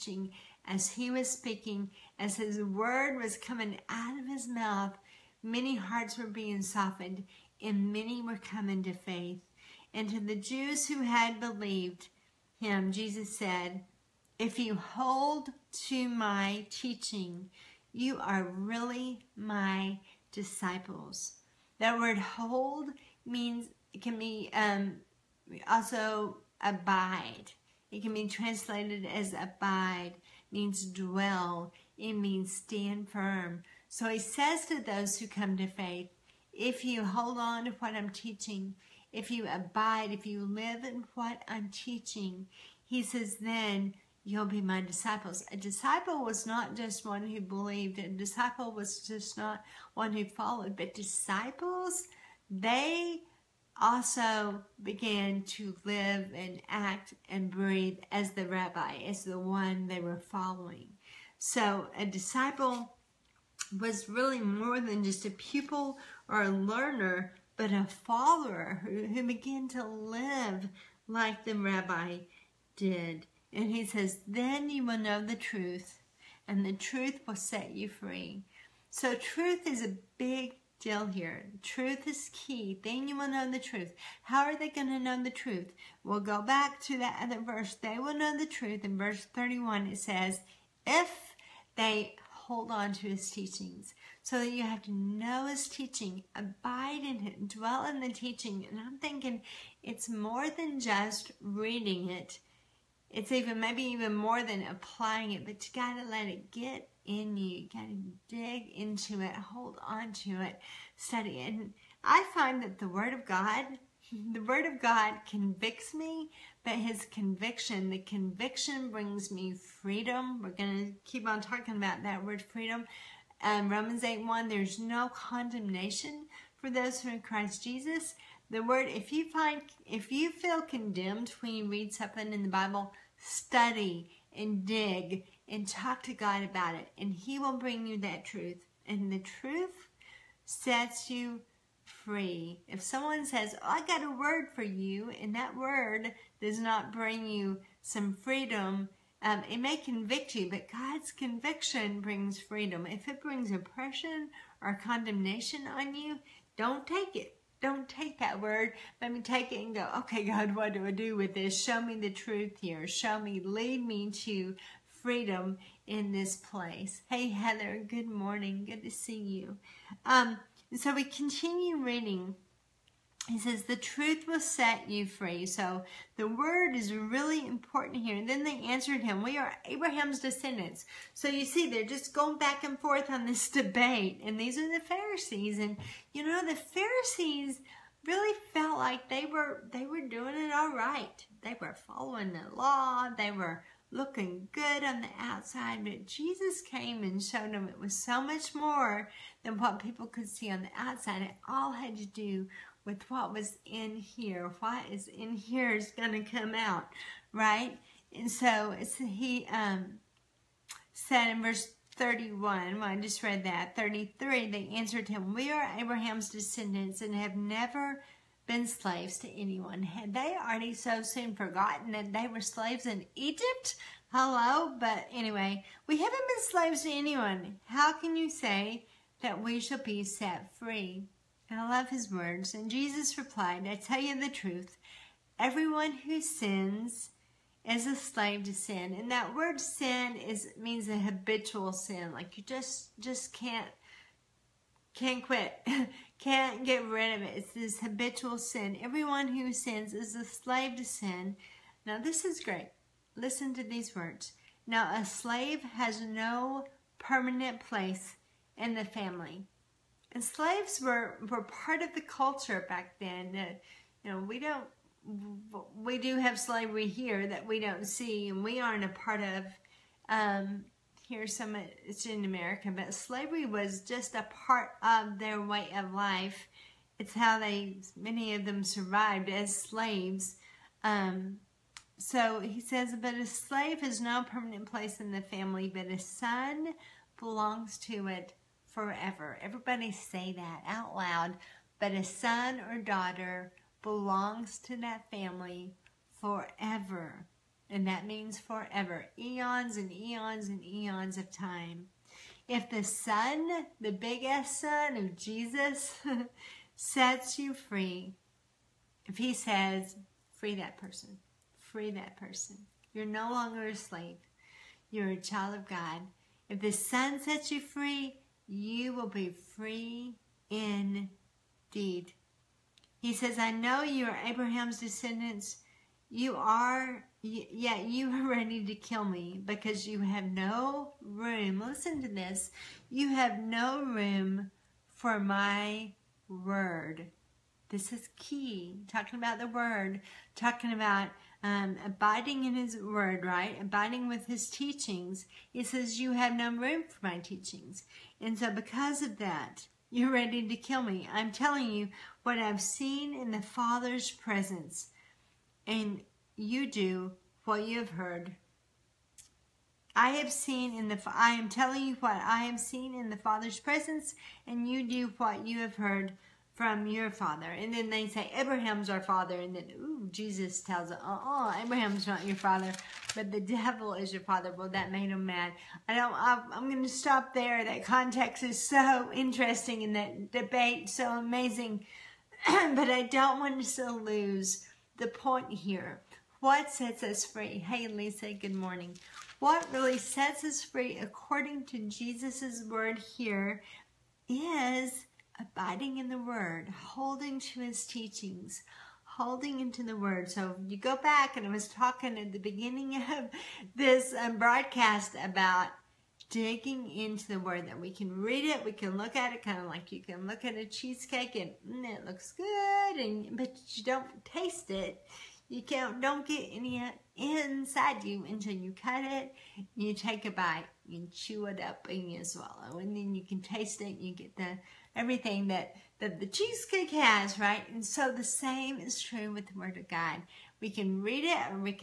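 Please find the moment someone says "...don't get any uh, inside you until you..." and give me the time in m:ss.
6:56.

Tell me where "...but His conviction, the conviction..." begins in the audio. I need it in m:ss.
1:56.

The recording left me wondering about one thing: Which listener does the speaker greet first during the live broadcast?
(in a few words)
Heather.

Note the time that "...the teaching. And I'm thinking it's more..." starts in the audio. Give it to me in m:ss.
1:37.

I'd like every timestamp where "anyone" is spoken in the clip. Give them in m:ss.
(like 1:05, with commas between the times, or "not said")
3:39, 3:46.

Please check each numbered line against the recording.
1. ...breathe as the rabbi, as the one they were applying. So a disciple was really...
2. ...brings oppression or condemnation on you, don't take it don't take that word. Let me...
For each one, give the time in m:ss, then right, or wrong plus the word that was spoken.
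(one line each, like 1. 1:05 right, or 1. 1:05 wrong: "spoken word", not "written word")
1. 0:57 wrong: "following", not "applying"
2. 2:33 right.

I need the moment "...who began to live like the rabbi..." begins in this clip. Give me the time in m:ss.
1:09.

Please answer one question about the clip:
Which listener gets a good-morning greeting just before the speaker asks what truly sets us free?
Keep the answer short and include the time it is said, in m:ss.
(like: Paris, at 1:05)
Lisa, at 6:27.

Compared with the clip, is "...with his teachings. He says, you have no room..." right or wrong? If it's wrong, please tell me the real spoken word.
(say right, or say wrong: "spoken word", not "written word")
right.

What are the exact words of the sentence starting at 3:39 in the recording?
Had they already so soon forgotten that they were slaves in Egypt?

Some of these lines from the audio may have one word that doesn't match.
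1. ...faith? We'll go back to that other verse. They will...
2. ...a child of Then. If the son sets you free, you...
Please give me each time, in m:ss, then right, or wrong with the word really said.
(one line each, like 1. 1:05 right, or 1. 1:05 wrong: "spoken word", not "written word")
1. 1:25 wrong: "truth", not "faith"
2. 5:15 wrong: "God", not "Then".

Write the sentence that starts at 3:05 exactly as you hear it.
And you know, the Pharisees really felt like they were, they were doing it all right.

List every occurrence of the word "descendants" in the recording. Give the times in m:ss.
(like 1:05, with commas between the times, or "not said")
3:00, 3:36, 5:24.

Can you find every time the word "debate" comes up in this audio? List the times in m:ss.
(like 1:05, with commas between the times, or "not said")
3:03, 6:20.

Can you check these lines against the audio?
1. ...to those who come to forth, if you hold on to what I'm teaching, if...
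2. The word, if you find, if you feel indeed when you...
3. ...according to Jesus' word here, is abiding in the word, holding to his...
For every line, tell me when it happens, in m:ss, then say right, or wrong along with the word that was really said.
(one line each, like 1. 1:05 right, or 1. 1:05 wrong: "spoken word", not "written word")
1. 0:34 wrong: "faith", not "forth"
2. 2:08 wrong: "condemned", not "indeed"
3. 6:30 right.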